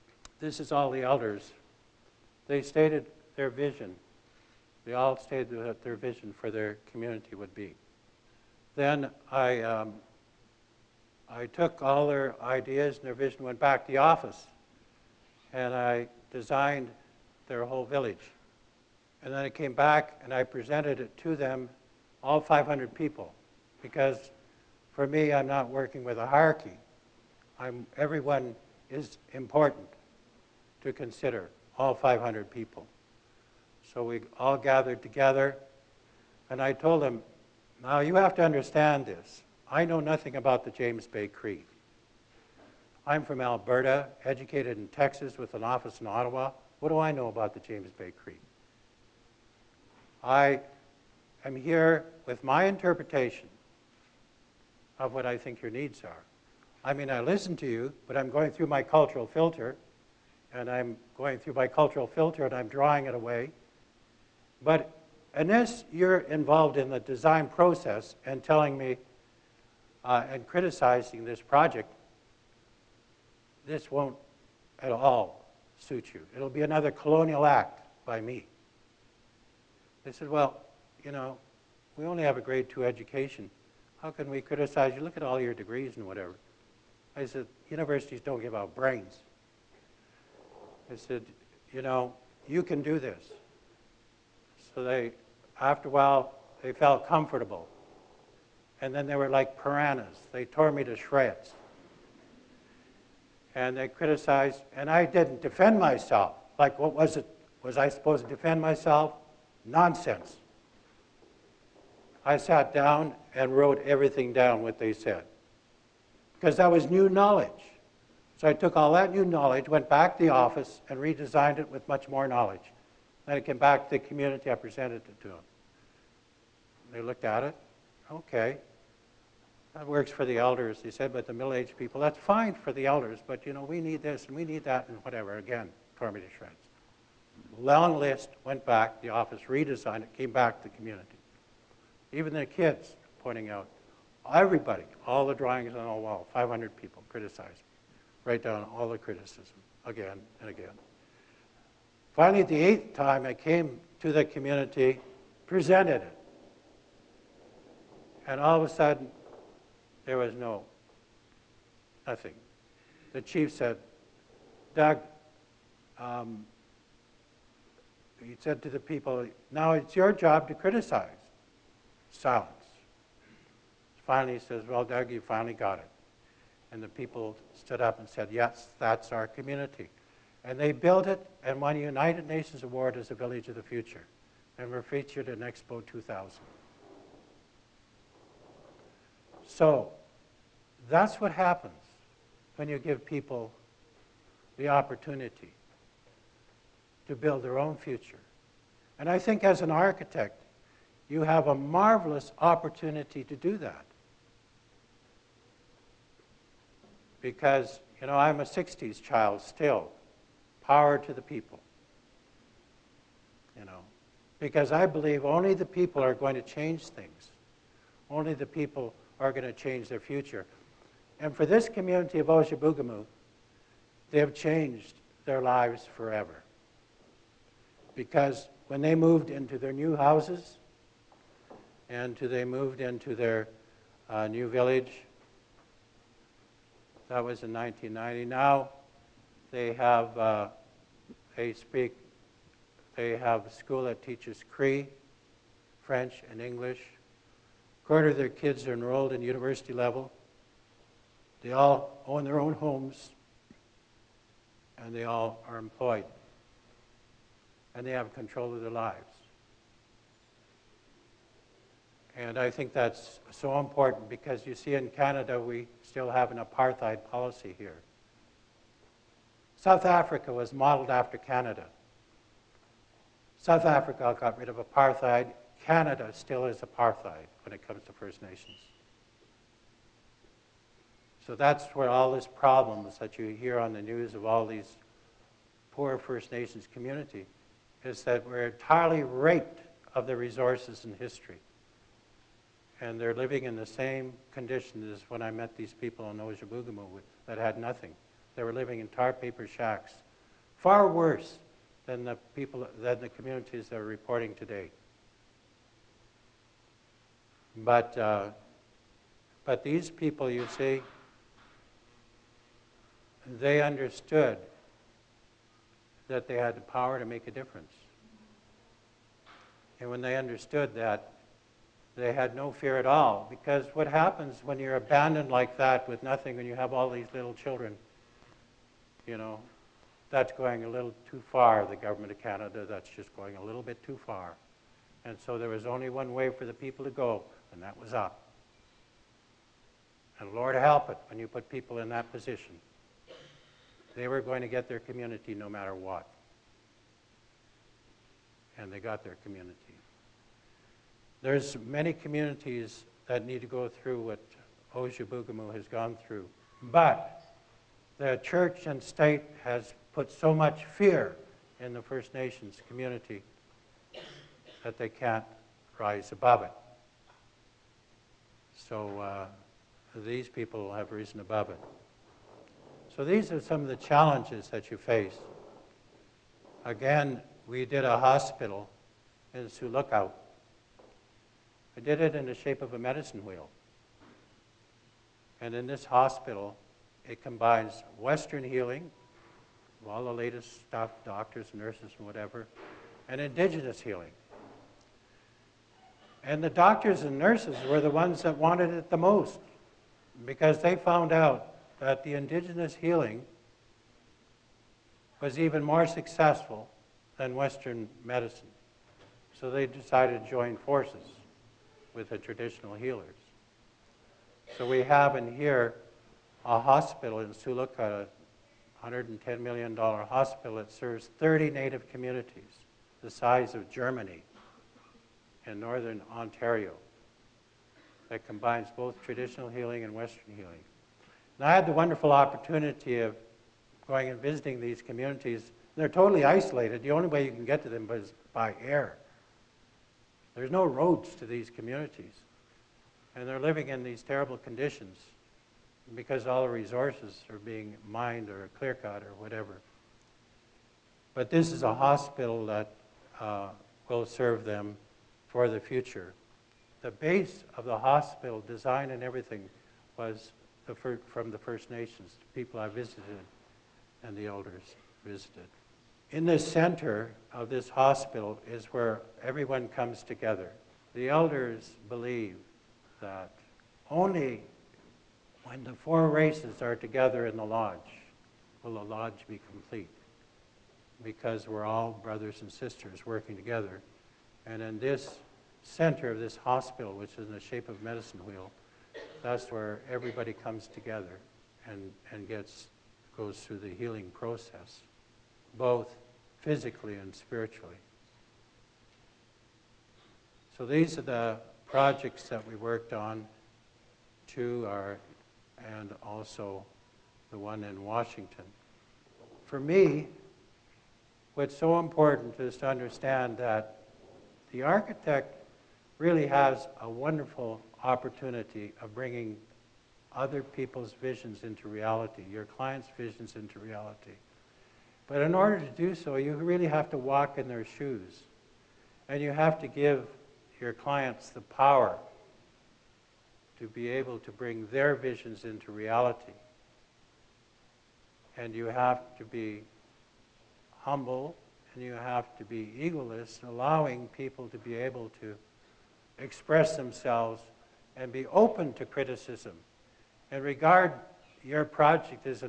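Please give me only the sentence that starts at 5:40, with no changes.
And Lord help it when you put people in that position.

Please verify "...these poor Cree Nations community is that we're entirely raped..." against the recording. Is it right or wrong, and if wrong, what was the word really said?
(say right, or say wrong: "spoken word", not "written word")
wrong: "First", not "Cree".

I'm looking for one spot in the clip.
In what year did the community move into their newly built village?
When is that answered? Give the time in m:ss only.
3:57.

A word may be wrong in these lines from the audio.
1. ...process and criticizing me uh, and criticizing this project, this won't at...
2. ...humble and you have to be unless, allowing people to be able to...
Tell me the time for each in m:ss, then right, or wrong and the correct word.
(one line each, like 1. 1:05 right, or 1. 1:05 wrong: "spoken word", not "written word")
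1. 1:07 wrong: "telling", not "criticizing"
2. 9:00 wrong: "egoless", not "unless".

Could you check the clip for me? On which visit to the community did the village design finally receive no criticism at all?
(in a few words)
eighth.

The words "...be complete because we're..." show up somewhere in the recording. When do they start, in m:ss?
7:59.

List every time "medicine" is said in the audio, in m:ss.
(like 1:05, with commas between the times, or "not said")
6:22, 6:48, 8:07.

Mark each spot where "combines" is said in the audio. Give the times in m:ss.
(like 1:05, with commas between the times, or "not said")
6:27, 7:08.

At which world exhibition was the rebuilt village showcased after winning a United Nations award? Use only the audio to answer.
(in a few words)
Expo 2000.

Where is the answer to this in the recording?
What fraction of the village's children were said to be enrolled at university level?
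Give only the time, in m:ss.
4:06.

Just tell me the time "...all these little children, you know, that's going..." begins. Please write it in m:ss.
5:26.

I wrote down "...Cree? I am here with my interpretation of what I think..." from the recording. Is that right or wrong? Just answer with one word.
right.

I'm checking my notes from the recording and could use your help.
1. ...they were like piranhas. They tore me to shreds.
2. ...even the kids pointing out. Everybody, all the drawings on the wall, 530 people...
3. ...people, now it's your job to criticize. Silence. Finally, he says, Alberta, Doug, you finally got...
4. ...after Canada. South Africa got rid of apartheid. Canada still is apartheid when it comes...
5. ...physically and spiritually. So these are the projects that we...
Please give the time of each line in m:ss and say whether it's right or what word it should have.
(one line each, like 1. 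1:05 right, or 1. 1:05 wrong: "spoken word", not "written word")
1. 1:39 right
2. 2:22 wrong: "500", not "530"
3. 2:48 wrong: "Well", not "Alberta"
4. 4:30 right
5. 8:16 right.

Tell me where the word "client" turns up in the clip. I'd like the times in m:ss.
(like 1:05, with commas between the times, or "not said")
8:42, 8:50.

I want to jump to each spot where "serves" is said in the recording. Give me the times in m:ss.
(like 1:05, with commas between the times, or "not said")
7:00, 7:34.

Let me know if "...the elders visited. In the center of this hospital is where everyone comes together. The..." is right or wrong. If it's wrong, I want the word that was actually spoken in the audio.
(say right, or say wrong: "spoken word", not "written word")
right.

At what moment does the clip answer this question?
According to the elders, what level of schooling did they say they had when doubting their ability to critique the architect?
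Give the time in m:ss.
1:22.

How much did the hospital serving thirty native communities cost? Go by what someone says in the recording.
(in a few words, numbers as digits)
$110 million.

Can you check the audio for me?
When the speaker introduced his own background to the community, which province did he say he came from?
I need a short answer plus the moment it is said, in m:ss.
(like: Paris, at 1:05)
Alberta, at 0:43.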